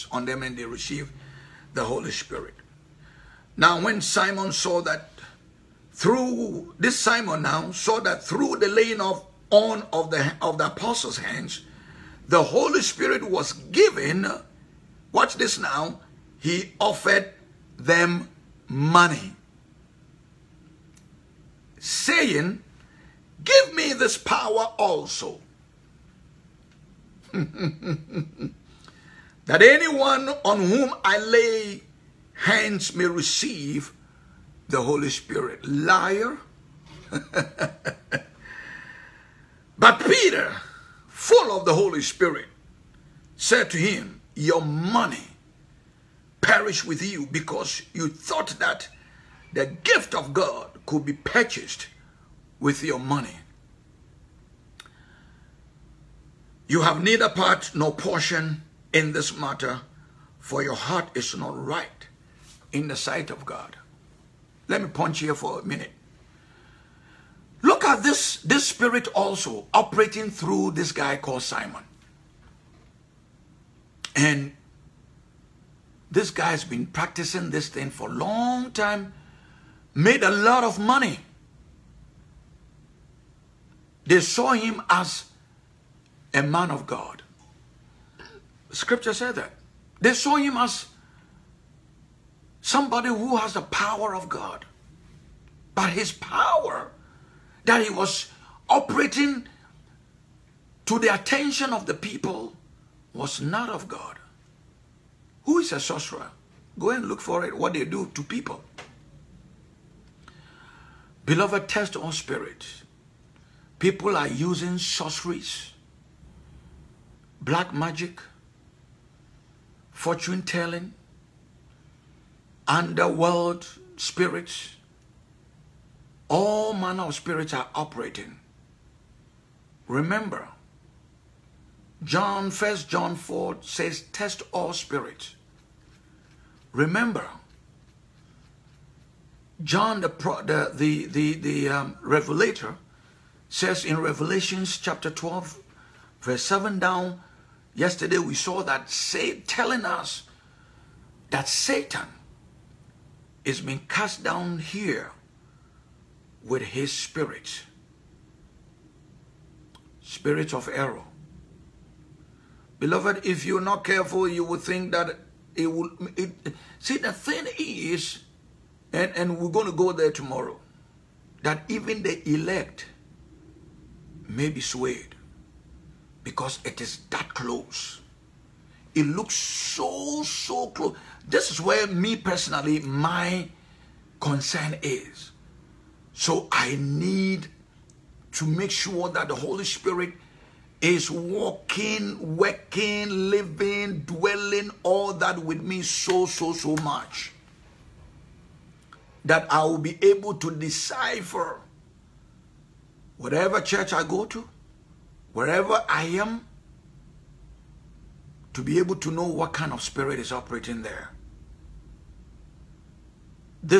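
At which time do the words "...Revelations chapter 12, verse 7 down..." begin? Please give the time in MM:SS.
02:24.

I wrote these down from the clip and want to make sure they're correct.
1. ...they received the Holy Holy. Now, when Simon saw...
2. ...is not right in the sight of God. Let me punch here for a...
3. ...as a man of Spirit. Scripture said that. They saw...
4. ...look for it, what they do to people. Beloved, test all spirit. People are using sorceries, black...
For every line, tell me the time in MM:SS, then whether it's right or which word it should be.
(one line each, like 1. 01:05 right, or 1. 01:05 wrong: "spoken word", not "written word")
1. 00:00 wrong: "Spirit", not "Holy"
2. 01:01 right
3. 01:24 wrong: "God", not "Spirit"
4. 01:47 right.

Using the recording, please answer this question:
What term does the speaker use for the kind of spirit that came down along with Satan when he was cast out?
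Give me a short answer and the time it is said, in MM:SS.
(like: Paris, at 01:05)
Spirit of error, at 02:40.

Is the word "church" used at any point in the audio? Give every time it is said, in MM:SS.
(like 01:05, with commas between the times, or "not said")
03:23.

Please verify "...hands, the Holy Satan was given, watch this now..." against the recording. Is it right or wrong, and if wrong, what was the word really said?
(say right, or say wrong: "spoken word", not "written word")
wrong: "Spirit", not "Satan".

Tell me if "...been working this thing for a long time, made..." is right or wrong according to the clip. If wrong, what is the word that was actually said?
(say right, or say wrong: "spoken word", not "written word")
wrong: "practicing", not "working".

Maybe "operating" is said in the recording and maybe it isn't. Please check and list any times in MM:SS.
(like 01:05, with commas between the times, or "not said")
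01:09, 01:38, 02:07, 03:30.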